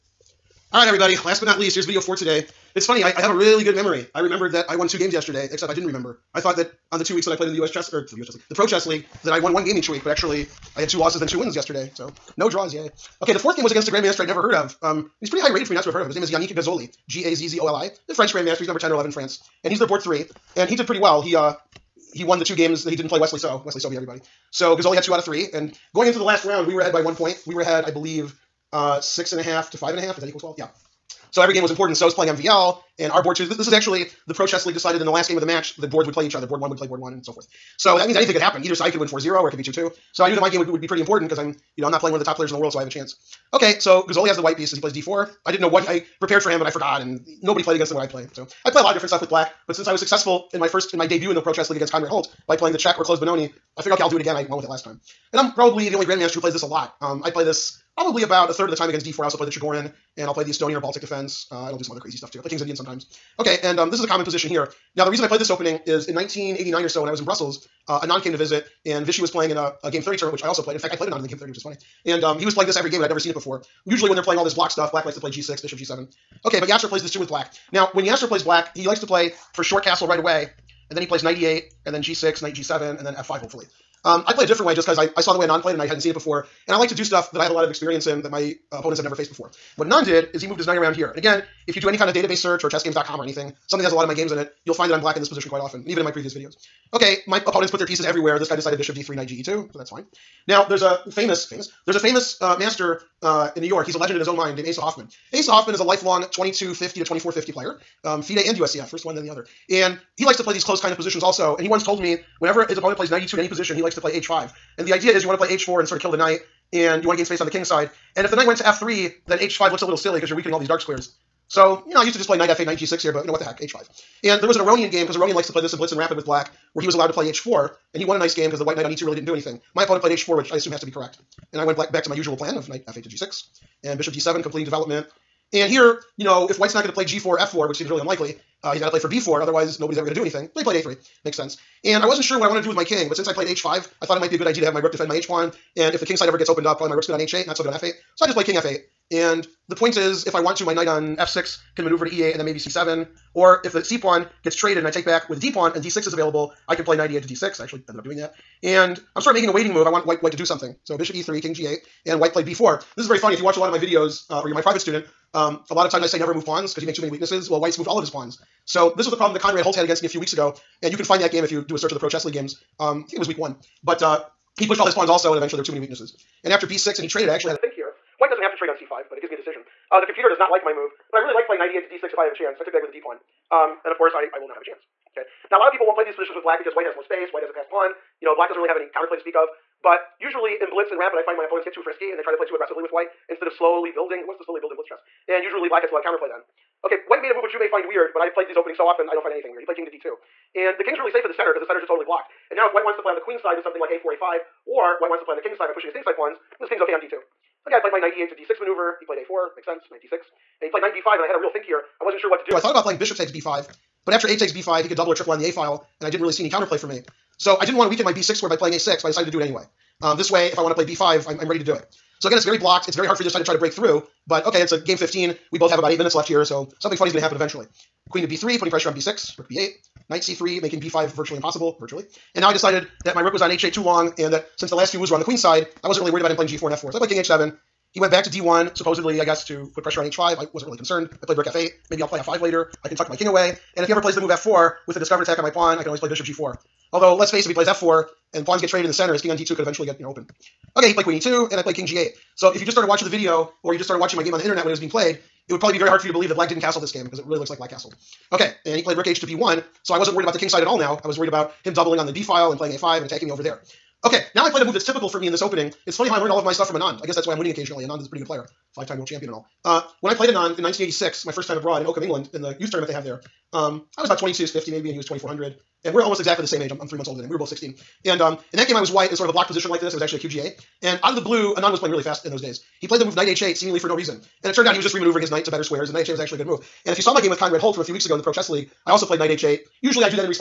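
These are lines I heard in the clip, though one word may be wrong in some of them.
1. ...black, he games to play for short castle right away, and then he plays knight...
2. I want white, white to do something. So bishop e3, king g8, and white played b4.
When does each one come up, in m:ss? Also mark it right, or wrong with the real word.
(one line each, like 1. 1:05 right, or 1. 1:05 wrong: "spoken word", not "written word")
1. 1:18 wrong: "likes", not "games"
2. 2:39 right.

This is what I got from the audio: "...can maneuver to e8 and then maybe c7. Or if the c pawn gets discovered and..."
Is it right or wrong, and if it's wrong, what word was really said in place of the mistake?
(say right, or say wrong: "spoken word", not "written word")
wrong: "traded", not "discovered".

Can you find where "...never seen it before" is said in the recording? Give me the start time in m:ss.
1:13.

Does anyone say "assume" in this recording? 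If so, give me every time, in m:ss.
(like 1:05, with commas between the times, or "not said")
2:10.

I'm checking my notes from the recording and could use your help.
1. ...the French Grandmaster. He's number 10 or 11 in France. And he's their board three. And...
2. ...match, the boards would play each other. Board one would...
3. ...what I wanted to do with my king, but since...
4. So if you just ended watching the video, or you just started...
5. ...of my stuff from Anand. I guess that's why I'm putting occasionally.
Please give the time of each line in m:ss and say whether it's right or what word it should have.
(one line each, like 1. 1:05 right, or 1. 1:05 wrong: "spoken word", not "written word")
1. 0:18 right
2. 0:35 right
3. 2:22 right
4. 4:12 wrong: "started", not "ended"
5. 4:26 wrong: "winning", not "putting".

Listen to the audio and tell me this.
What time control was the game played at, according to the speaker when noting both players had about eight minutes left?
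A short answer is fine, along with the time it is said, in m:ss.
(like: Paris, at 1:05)
Game 15, at 3:44.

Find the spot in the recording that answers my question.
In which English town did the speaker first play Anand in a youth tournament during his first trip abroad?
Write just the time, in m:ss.
4:31.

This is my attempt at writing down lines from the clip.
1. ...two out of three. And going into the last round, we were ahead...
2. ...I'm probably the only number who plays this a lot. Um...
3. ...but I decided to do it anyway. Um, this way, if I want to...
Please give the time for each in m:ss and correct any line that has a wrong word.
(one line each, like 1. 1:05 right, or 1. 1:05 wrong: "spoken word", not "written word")
1. 0:25 right
2. 0:55 wrong: "grandmaster", not "number"
3. 3:39 right.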